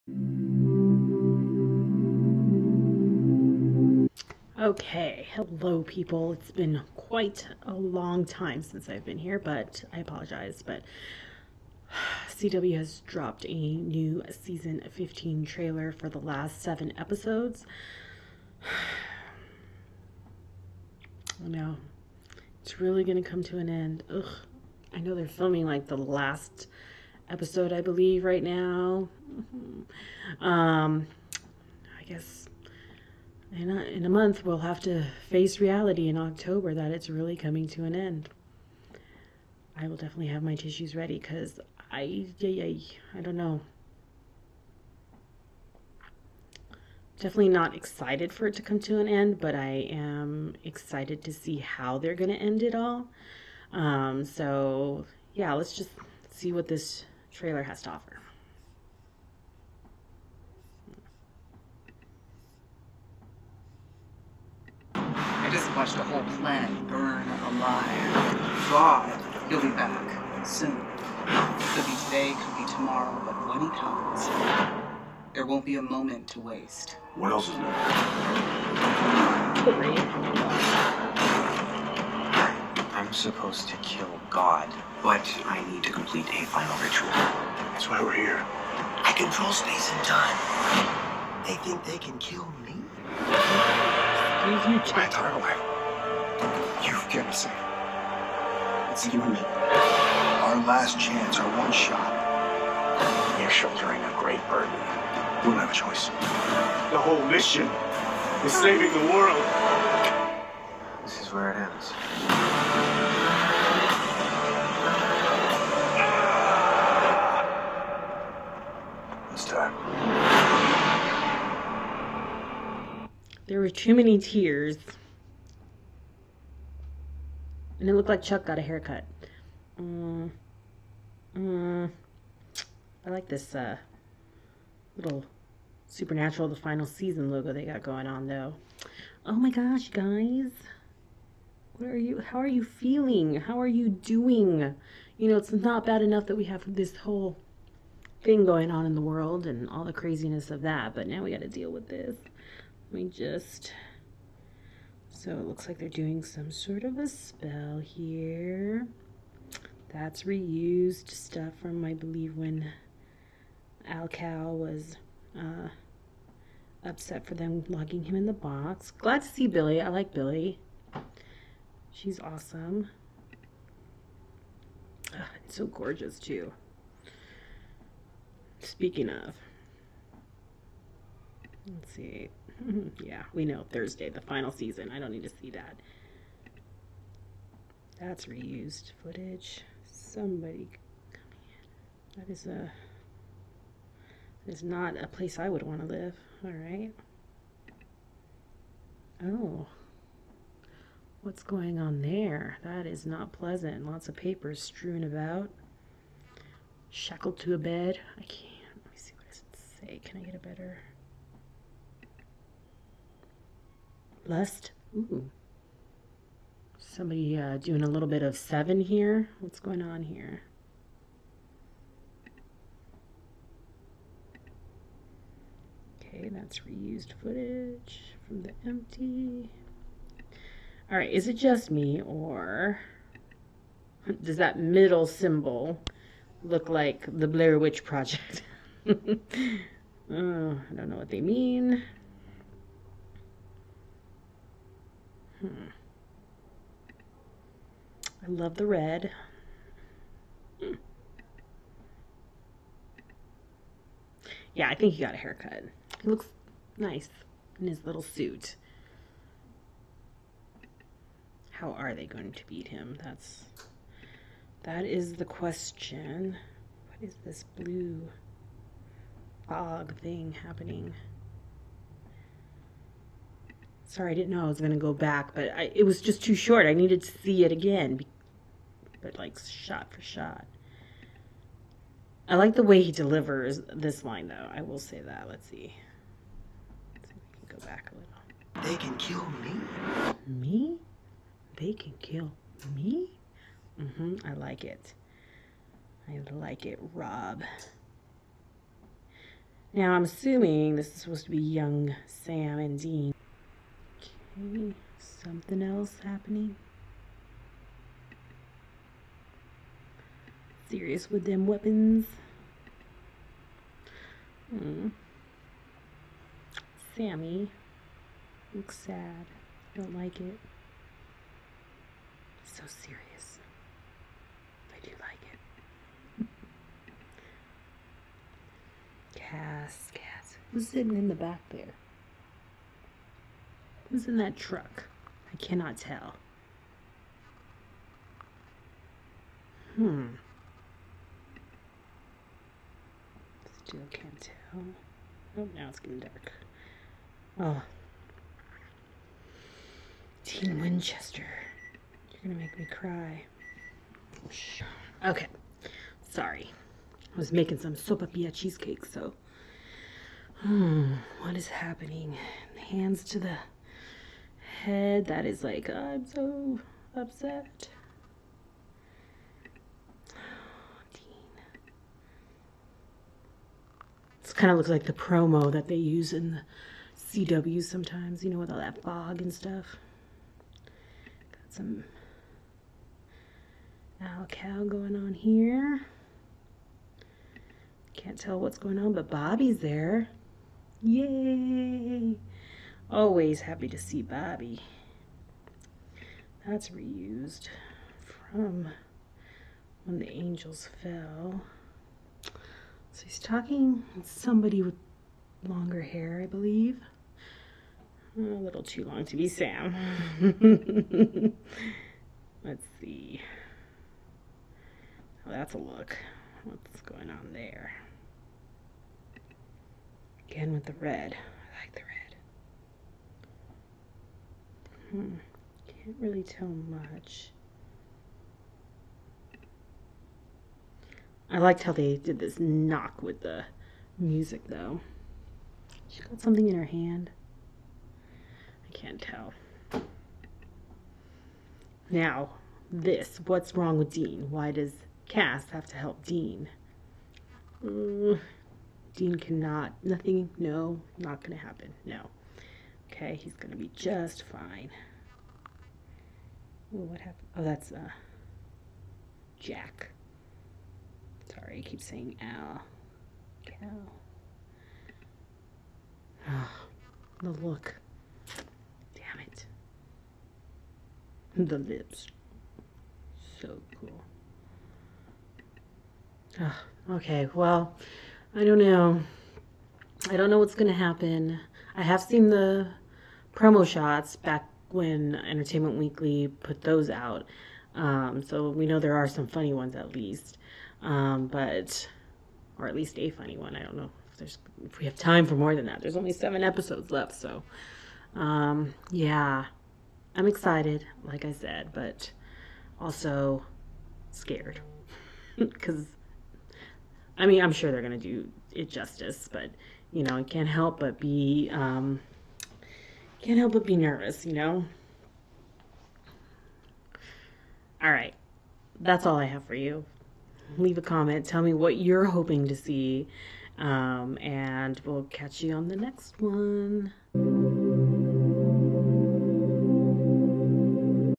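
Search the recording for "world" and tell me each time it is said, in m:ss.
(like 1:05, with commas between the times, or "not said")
1:49, 2:29.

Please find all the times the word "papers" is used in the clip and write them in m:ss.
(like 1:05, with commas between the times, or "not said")
3:24.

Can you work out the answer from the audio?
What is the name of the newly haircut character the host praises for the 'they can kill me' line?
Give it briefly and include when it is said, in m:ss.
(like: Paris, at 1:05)
Rob, at 4:56.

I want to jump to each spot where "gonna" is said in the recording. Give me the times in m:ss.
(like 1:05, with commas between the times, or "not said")
5:52, 8:27.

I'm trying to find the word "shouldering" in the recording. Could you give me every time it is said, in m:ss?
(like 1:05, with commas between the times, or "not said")
1:43.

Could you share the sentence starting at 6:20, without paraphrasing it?
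Got some Alcal going on here.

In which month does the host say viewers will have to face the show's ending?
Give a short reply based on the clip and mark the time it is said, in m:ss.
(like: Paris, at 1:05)
October, at 0:36.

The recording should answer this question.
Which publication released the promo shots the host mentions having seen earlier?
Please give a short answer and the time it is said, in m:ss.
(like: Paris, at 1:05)
Entertainment Weekly, at 8:05.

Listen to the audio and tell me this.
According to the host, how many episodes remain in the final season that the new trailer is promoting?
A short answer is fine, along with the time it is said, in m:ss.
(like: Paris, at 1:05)
7, at 0:16.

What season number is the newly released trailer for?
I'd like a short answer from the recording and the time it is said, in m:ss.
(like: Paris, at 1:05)
15, at 0:14.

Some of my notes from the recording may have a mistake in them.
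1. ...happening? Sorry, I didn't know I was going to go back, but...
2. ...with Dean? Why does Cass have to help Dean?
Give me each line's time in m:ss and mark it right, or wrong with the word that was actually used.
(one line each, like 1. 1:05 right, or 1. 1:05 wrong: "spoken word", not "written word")
1. 4:30 right
2. 7:23 right.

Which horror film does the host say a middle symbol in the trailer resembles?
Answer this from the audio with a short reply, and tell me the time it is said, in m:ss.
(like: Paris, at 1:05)
The Blair Witch Project, at 3:57.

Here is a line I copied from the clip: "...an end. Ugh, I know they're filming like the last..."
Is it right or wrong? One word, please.
right.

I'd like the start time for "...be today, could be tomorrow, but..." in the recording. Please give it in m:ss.
1:11.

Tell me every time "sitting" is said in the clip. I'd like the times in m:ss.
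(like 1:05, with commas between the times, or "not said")
5:30.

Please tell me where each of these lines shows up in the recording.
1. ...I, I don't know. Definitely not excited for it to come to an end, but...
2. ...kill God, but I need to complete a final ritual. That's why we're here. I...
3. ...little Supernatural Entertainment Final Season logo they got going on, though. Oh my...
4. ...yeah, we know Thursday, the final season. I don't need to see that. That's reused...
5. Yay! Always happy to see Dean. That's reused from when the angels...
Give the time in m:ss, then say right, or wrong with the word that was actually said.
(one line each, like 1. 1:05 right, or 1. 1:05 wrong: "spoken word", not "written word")
1. 0:42 right
2. 1:23 right
3. 2:14 wrong: "The", not "Entertainment"
4. 3:03 right
5. 6:30 wrong: "Bobby", not "Dean".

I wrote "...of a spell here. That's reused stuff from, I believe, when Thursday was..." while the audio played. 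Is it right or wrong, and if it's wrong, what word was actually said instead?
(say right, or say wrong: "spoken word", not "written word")
wrong: "Alcal", not "Thursday".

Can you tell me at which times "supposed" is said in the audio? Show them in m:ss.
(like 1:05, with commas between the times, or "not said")
1:23, 5:01.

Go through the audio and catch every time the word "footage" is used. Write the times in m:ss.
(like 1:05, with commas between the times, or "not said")
3:09, 3:47.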